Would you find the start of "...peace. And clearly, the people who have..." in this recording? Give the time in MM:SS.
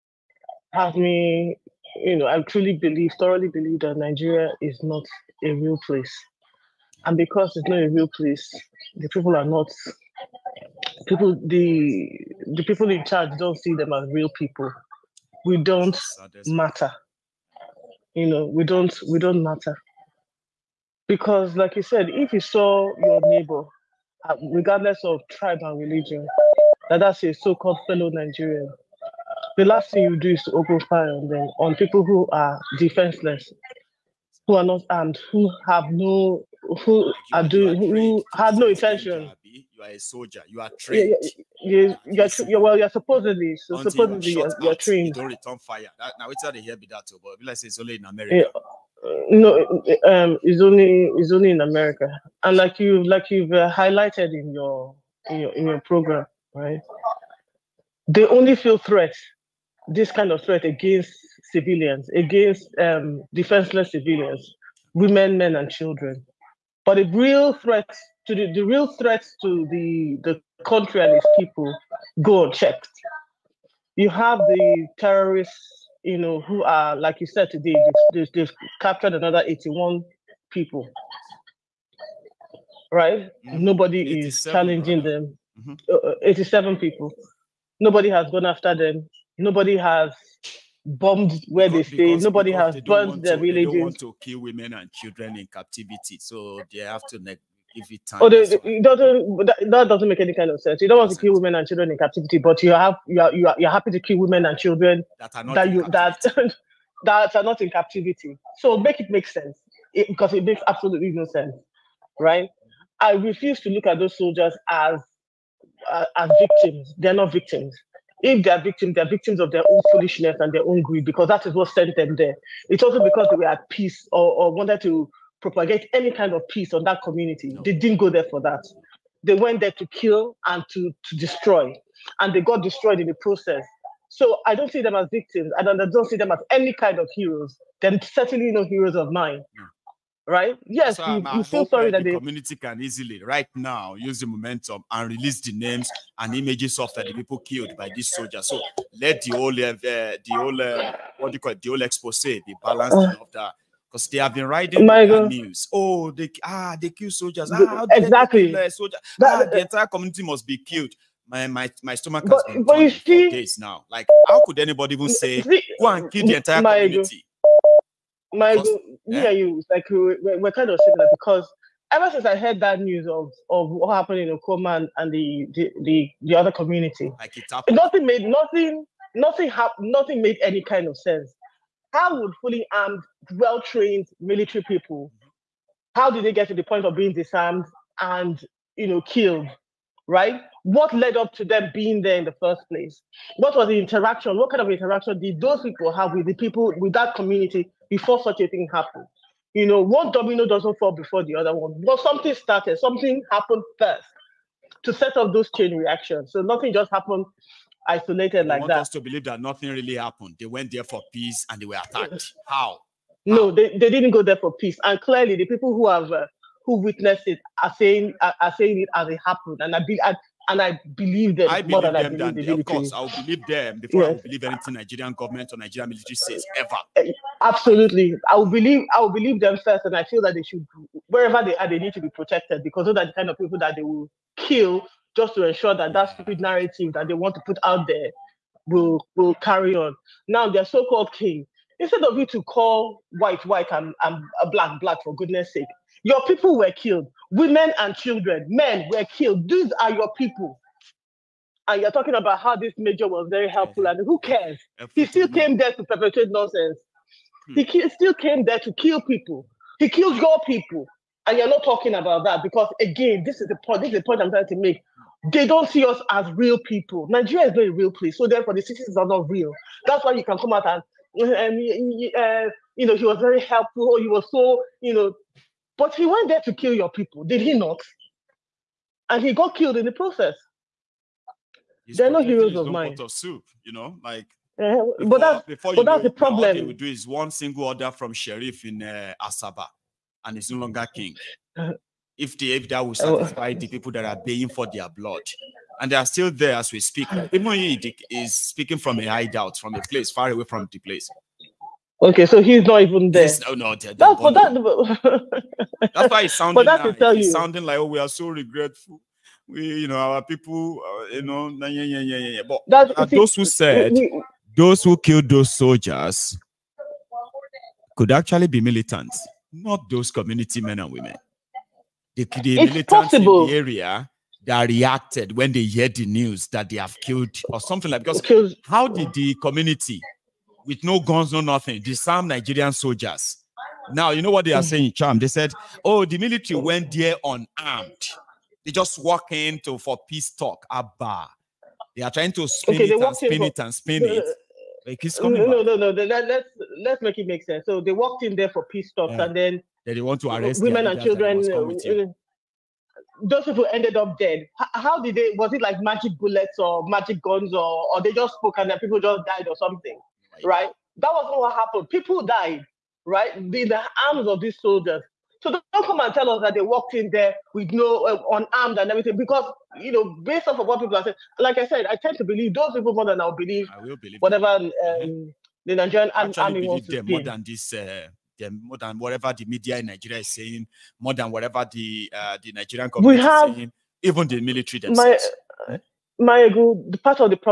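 03:34.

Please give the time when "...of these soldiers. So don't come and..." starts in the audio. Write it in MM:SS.
06:04.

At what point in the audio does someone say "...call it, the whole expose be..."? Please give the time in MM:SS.
02:31.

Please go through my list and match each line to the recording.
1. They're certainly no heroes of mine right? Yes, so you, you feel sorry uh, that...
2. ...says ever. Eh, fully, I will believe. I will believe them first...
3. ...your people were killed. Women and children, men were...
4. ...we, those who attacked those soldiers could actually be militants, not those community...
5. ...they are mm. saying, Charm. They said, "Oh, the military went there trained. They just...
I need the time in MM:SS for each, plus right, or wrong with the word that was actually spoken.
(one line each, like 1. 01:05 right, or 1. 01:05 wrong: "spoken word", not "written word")
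1. 02:17 right
2. 03:46 wrong: "absolutely", not "fully"
3. 04:06 right
4. 05:14 wrong: "killed", not "attacked"
5. 05:34 wrong: "unarmed", not "trained".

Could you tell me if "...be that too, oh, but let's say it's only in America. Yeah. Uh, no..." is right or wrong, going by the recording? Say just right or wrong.
right.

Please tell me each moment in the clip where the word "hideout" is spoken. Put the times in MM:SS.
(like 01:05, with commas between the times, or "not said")
04:59.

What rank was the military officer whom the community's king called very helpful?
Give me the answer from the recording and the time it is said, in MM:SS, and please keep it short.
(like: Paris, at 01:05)
Major, at 04:12.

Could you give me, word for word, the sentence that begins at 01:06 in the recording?
But the real threat to the, the real threats to the, the country and its people go unchecked.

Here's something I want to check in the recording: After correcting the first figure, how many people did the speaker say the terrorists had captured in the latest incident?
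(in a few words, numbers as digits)
87.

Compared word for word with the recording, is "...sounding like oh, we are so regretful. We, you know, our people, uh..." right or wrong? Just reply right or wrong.
right.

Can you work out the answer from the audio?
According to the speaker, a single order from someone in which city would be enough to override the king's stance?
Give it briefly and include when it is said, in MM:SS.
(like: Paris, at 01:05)
Asaba, at 04:49.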